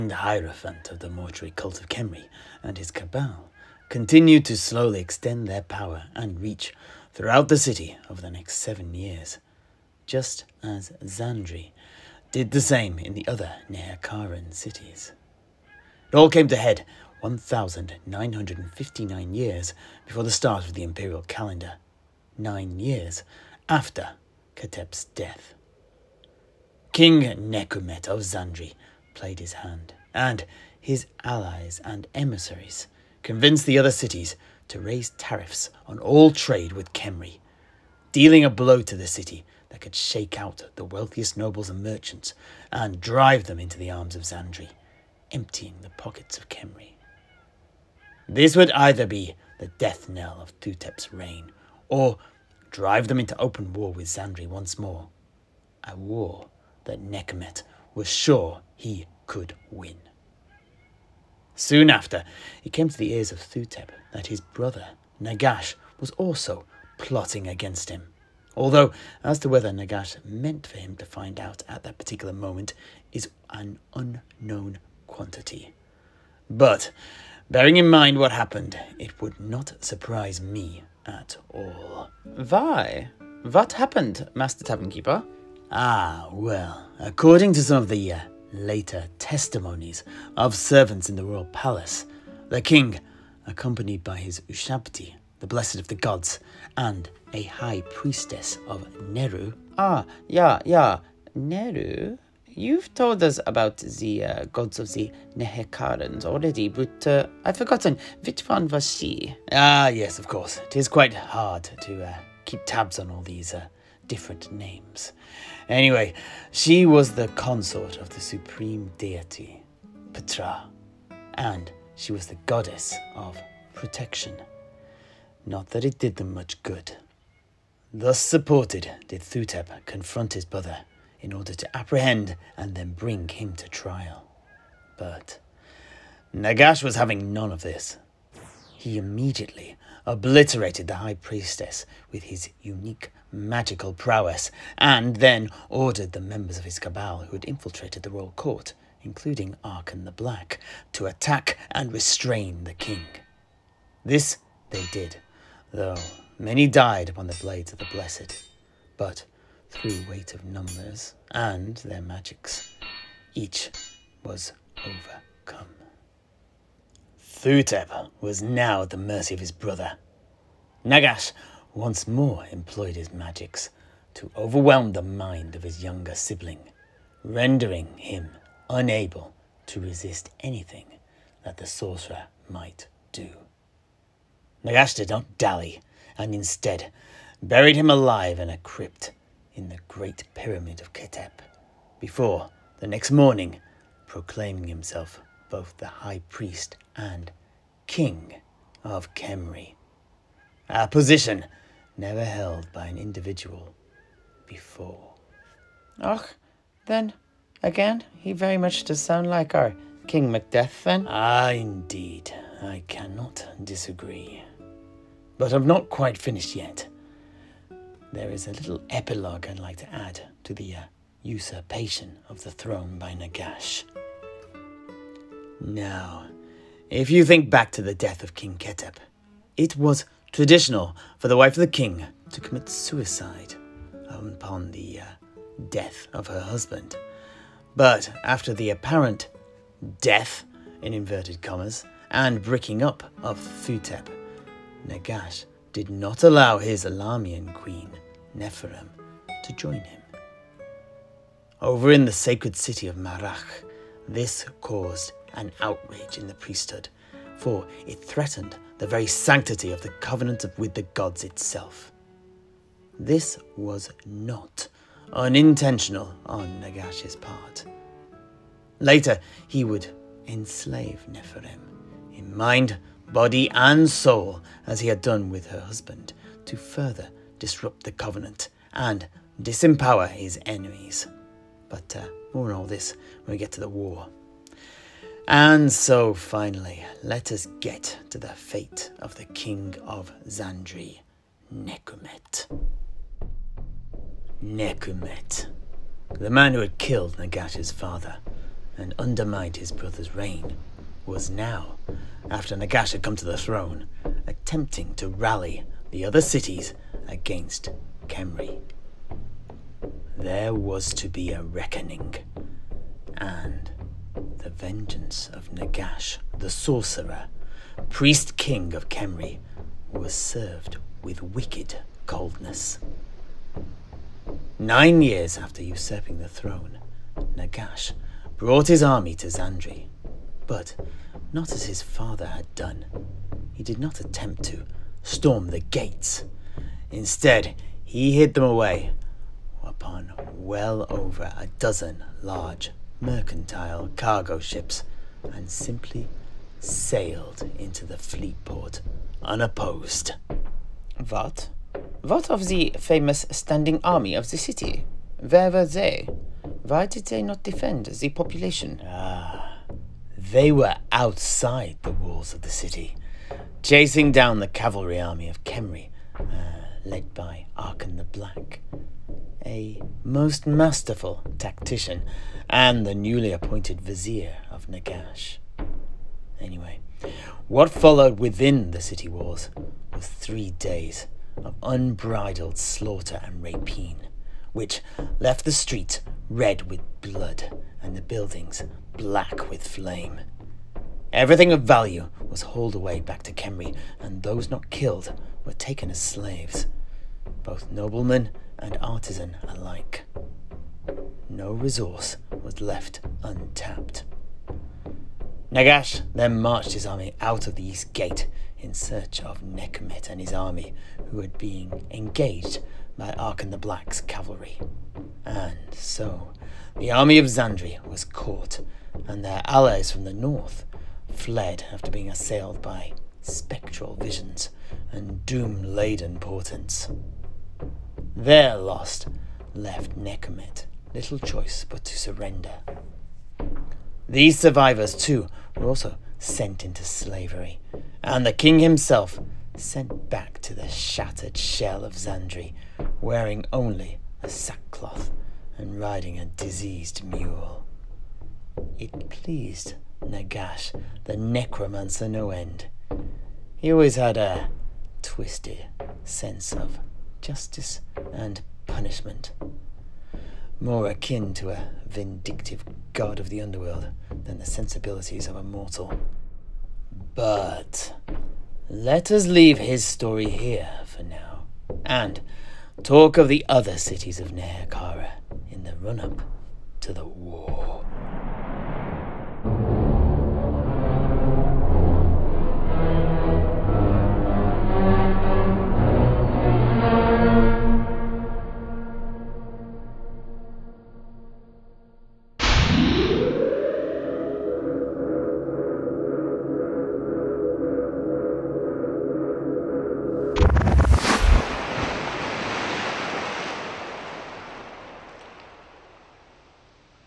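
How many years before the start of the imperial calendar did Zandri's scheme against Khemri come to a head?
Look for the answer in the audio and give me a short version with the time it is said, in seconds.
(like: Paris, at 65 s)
1,959, at 17 s.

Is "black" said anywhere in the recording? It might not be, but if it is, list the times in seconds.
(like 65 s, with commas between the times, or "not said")
150 s, 368 s, 388 s, 413 s.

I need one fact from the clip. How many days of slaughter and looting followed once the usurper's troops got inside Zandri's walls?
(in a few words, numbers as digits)
3.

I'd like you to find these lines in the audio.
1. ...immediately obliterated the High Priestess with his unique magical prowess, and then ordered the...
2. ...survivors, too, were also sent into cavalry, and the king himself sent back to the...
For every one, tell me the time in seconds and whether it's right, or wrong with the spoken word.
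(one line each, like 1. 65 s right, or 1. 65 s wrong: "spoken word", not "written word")
1. 138 s right
2. 434 s wrong: "slavery", not "cavalry".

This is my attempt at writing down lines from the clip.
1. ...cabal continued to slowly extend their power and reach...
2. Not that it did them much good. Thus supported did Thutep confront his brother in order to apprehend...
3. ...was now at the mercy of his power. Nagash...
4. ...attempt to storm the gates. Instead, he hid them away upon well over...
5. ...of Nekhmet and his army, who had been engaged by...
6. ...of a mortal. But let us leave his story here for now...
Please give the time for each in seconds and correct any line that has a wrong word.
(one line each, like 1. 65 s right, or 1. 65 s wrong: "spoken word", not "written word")
1. 2 s right
2. 125 s right
3. 168 s wrong: "brother", not "power"
4. 333 s right
5. 409 s right
6. 465 s right.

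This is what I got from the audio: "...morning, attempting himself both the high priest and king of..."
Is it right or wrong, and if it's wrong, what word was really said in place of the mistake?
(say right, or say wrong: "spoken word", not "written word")
wrong: "proclaiming", not "attempting".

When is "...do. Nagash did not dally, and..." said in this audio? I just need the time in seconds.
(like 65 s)
183 s.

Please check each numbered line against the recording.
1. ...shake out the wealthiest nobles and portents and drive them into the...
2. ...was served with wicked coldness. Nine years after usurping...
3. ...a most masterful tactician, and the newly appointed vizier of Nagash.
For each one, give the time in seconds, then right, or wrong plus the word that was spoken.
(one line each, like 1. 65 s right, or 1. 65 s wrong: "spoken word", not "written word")
1. 39 s wrong: "merchants", not "portents"
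2. 319 s right
3. 369 s right.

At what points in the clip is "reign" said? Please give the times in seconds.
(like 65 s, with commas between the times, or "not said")
51 s, 300 s.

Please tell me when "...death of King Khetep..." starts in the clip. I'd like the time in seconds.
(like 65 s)
227 s.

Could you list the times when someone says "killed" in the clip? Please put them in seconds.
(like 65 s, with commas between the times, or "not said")
296 s, 394 s.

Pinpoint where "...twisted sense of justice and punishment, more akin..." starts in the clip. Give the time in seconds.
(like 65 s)
455 s.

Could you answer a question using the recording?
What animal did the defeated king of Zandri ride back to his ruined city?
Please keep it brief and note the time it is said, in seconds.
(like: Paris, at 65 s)
A diseased mule, at 446 s.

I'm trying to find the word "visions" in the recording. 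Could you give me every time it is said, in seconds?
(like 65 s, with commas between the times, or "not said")
423 s.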